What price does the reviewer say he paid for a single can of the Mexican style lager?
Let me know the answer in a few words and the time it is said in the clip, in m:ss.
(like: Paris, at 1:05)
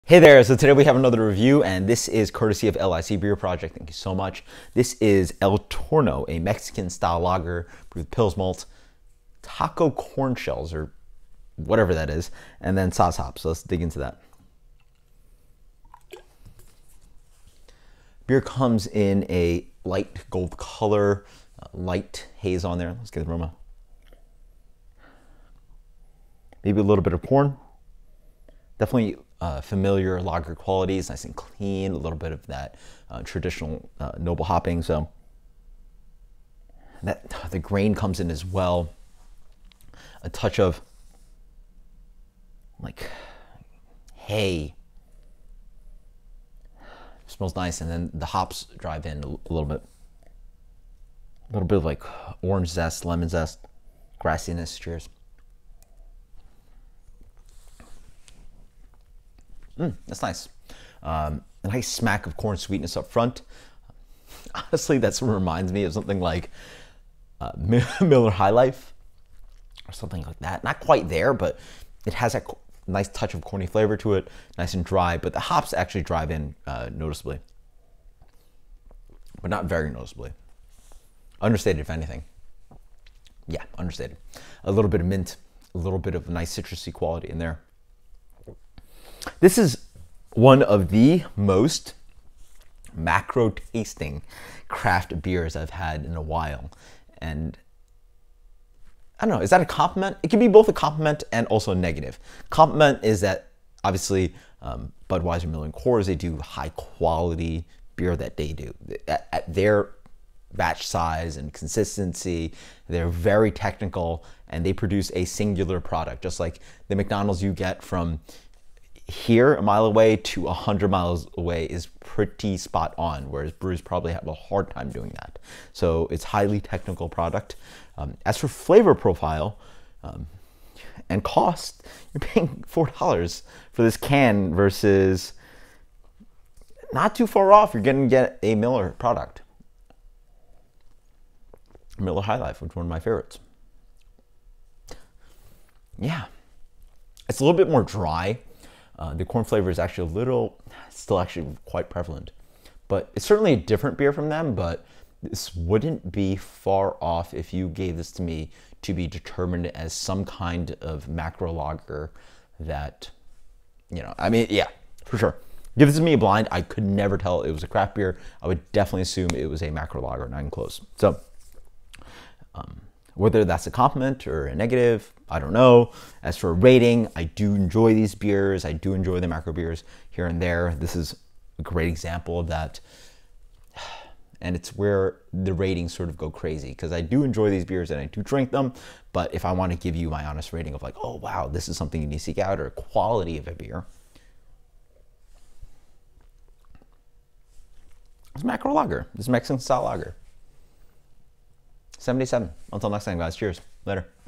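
$4, at 2:12.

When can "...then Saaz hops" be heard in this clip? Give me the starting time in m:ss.
0:12.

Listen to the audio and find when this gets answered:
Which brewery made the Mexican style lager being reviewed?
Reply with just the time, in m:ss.
0:02.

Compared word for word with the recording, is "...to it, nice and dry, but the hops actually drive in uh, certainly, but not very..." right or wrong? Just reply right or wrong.
wrong.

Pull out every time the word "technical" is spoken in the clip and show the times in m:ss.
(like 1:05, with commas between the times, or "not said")
1:53, 2:06.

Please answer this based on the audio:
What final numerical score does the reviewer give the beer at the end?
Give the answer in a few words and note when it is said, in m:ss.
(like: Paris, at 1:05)
77, at 3:22.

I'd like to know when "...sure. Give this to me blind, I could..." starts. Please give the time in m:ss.
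2:45.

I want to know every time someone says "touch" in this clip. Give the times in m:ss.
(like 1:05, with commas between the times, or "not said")
0:40, 1:13.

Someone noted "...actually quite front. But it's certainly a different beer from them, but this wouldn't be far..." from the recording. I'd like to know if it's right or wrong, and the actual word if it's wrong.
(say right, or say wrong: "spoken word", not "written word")
wrong: "prevalent", not "front".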